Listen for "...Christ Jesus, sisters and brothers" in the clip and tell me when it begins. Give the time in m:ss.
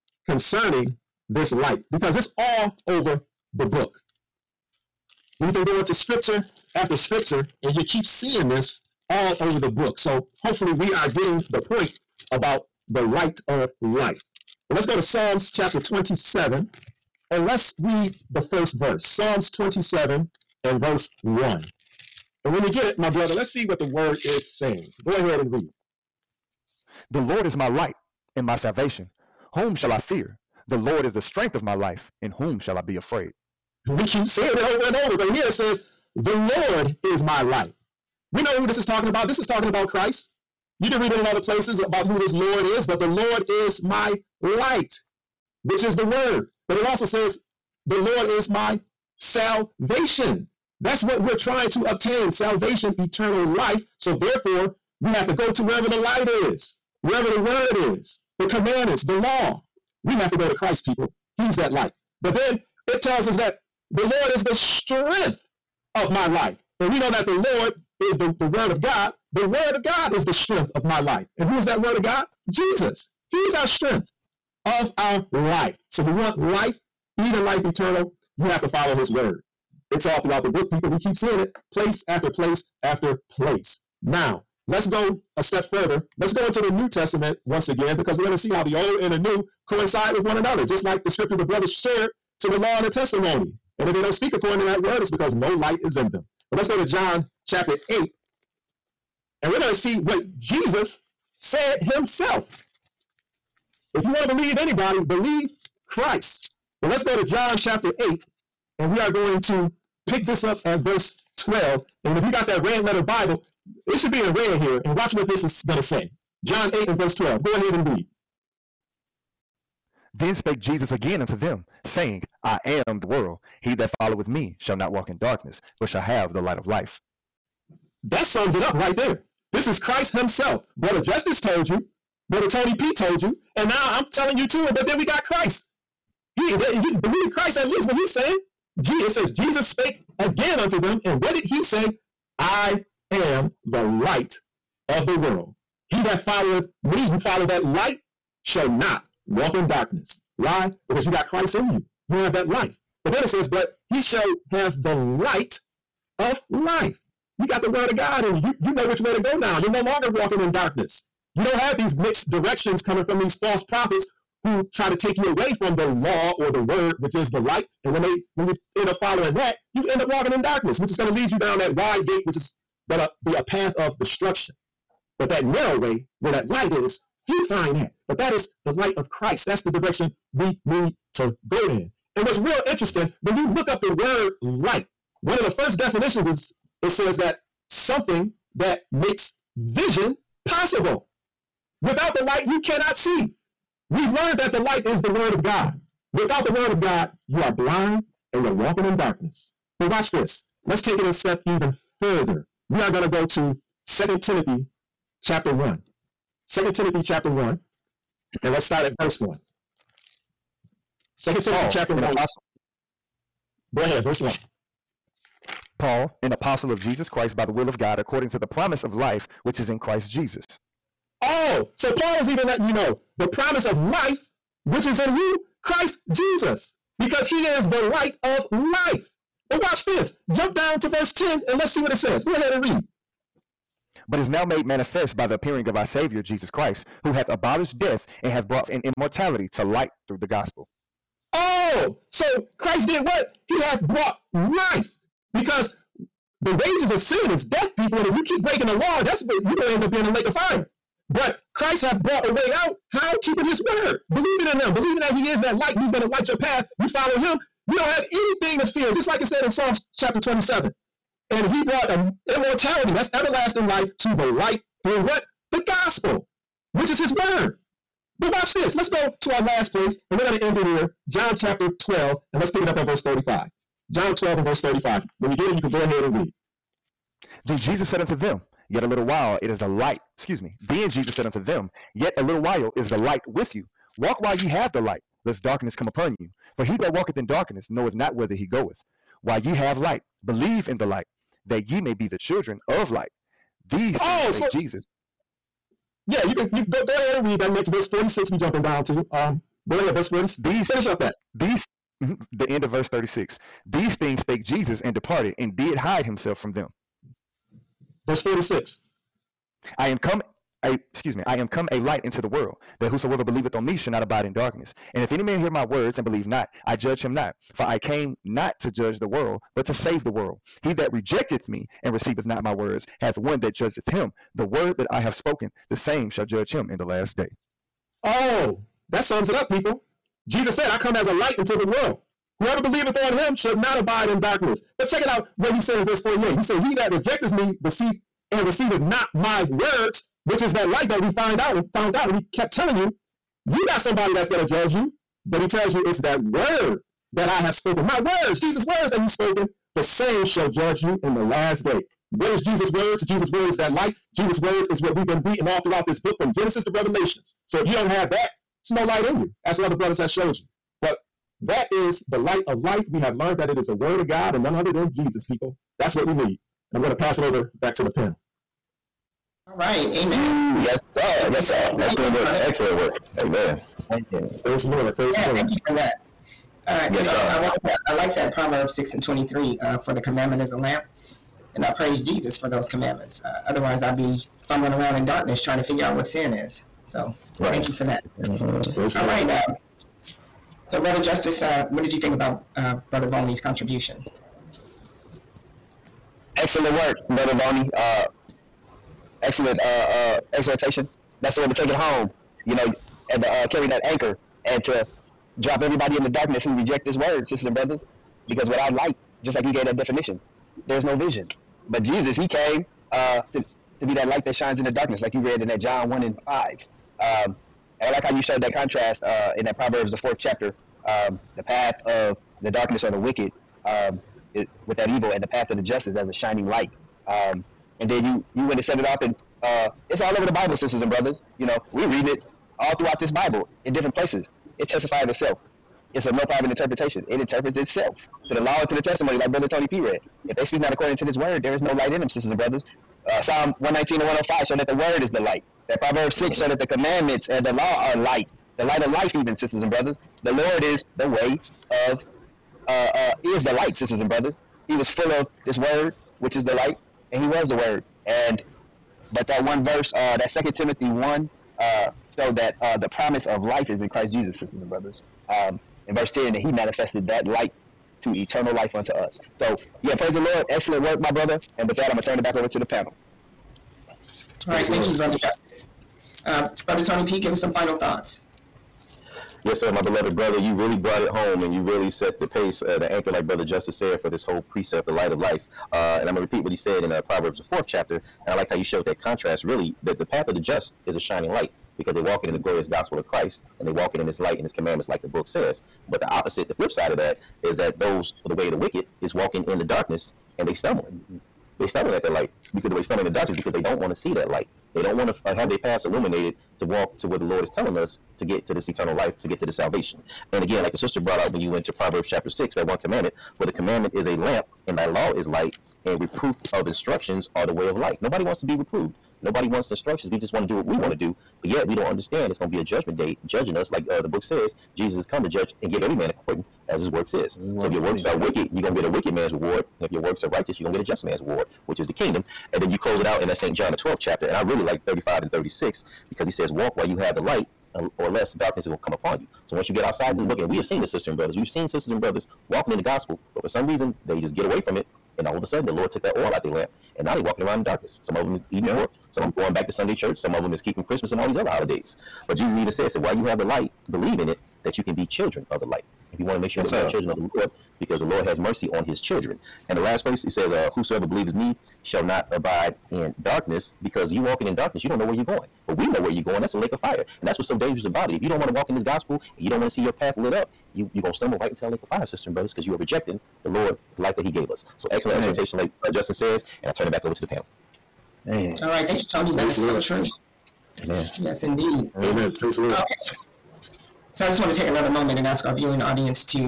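7:43.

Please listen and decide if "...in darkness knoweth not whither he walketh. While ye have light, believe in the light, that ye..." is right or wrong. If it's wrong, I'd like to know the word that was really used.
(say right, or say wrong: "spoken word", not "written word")
wrong: "goeth", not "walketh".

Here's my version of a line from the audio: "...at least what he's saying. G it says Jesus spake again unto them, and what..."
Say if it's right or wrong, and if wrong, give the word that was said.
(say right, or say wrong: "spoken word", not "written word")
right.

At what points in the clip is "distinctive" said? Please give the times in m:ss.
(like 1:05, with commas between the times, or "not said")
not said.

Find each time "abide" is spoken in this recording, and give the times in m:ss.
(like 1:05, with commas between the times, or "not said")
5:14, 5:33, 9:22.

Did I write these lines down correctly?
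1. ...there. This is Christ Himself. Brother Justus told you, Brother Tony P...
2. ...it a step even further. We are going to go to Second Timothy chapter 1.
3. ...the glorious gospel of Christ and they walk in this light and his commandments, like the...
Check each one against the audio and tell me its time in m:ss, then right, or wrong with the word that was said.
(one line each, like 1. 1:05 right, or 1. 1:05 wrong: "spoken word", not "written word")
1. 2:08 right
2. 3:20 right
3. 8:12 right.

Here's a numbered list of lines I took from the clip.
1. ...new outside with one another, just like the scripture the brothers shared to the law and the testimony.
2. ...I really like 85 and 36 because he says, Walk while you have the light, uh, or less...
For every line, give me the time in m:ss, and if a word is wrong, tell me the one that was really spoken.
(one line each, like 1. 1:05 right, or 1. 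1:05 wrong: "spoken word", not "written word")
1. 1:29 wrong: "coincide", not "outside"
2. 8:54 wrong: "35", not "85".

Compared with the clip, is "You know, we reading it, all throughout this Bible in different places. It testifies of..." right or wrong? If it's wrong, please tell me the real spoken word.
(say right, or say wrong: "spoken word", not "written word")
right.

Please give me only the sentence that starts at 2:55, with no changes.
But that narrow way where that light is, few find that.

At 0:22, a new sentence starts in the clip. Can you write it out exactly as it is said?
And when you get it, my brother, let's see what the word is saying.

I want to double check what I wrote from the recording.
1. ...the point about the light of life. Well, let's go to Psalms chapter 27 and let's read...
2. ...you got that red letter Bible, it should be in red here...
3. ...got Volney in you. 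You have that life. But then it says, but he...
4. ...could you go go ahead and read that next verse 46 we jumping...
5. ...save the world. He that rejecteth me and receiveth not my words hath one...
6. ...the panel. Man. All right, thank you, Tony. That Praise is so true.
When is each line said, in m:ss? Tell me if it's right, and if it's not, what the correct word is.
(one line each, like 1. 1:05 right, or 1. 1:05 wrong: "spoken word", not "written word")
1. 0:11 right
2. 1:52 right
3. 2:31 wrong: "Christ", not "Volney"
4. 4:56 right
5. 5:19 right
6. 9:37 right.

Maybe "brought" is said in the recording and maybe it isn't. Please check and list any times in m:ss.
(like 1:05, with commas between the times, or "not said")
3:58, 4:03, 4:11, 4:21, 8:00, 8:30.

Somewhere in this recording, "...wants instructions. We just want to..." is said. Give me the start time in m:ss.
8:39.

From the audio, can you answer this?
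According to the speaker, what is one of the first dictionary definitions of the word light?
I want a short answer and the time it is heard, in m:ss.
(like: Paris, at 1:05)
something that makes vision possible, at 3:07.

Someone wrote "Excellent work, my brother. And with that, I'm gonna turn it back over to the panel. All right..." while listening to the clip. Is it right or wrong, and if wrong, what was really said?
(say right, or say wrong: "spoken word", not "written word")
right.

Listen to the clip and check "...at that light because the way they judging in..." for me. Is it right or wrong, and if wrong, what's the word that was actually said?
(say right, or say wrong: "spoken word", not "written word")
wrong: "stumbling", not "judging".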